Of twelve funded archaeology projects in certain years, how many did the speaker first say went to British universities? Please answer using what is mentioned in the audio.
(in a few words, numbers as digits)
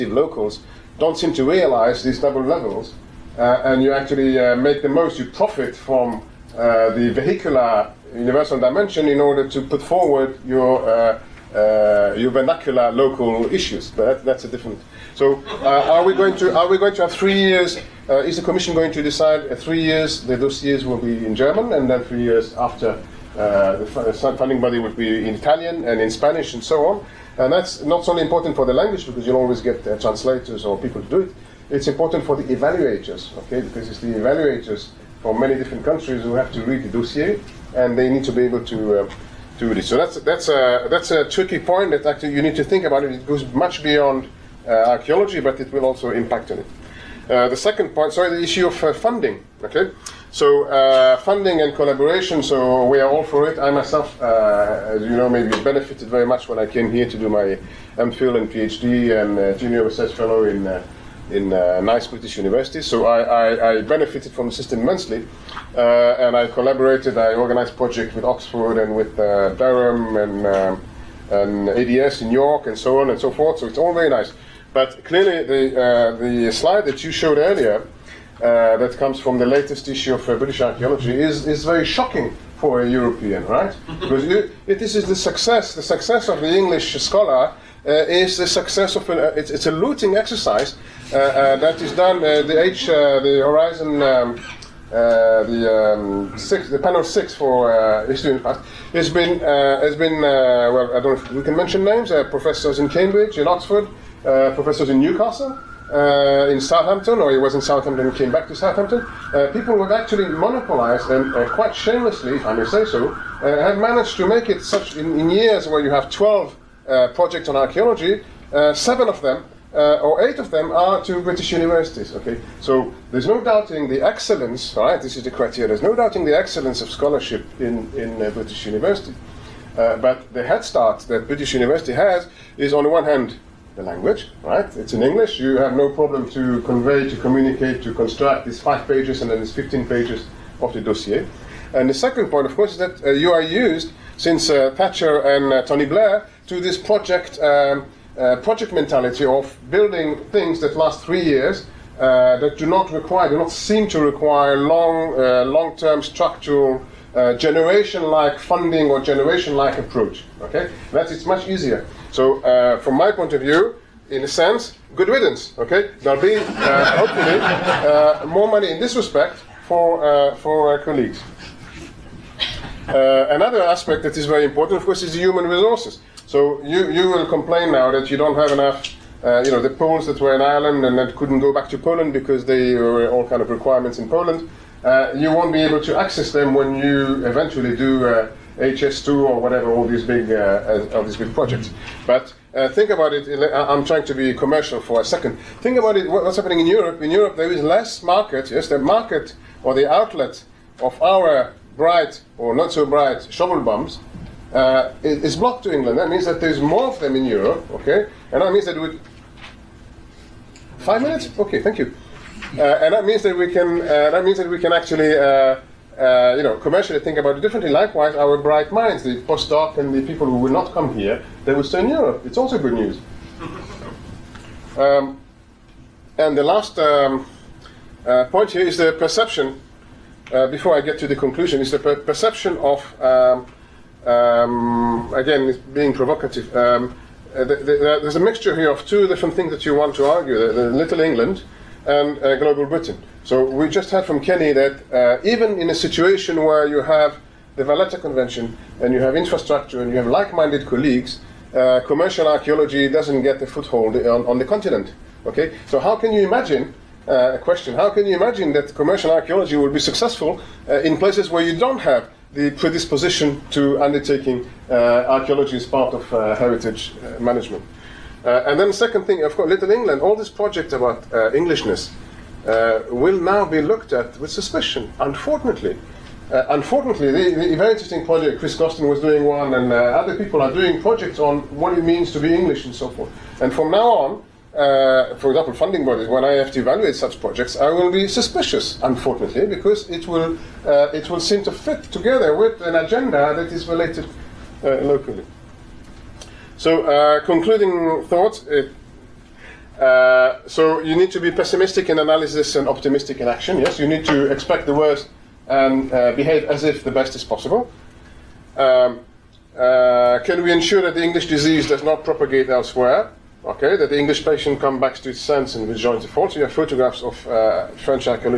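7.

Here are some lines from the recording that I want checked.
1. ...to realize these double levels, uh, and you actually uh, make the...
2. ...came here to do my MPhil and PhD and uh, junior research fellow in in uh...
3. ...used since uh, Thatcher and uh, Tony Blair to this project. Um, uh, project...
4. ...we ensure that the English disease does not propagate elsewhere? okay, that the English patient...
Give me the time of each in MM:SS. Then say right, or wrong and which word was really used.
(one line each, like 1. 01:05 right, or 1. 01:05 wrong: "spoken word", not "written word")
1. 00:01 right
2. 00:56 right
3. 02:23 right
4. 05:10 right.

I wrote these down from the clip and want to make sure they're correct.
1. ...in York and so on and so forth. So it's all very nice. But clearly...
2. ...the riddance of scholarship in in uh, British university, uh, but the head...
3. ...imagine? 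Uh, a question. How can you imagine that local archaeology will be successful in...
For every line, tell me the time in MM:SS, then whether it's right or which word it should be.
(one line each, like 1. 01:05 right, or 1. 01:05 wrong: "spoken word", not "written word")
1. 01:12 right
2. 02:06 wrong: "excellence", not "riddance"
3. 04:16 wrong: "commercial", not "local".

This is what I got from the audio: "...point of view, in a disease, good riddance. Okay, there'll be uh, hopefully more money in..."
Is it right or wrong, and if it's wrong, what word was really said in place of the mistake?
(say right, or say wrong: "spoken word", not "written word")
wrong: "sense", not "disease".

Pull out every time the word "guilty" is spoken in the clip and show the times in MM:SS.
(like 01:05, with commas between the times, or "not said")
not said.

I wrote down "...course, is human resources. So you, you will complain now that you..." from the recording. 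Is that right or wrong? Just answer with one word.
right.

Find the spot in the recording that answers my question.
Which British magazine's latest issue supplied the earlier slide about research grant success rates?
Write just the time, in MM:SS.
01:20.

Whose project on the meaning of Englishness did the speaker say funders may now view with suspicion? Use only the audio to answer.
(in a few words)
Chris Gosden.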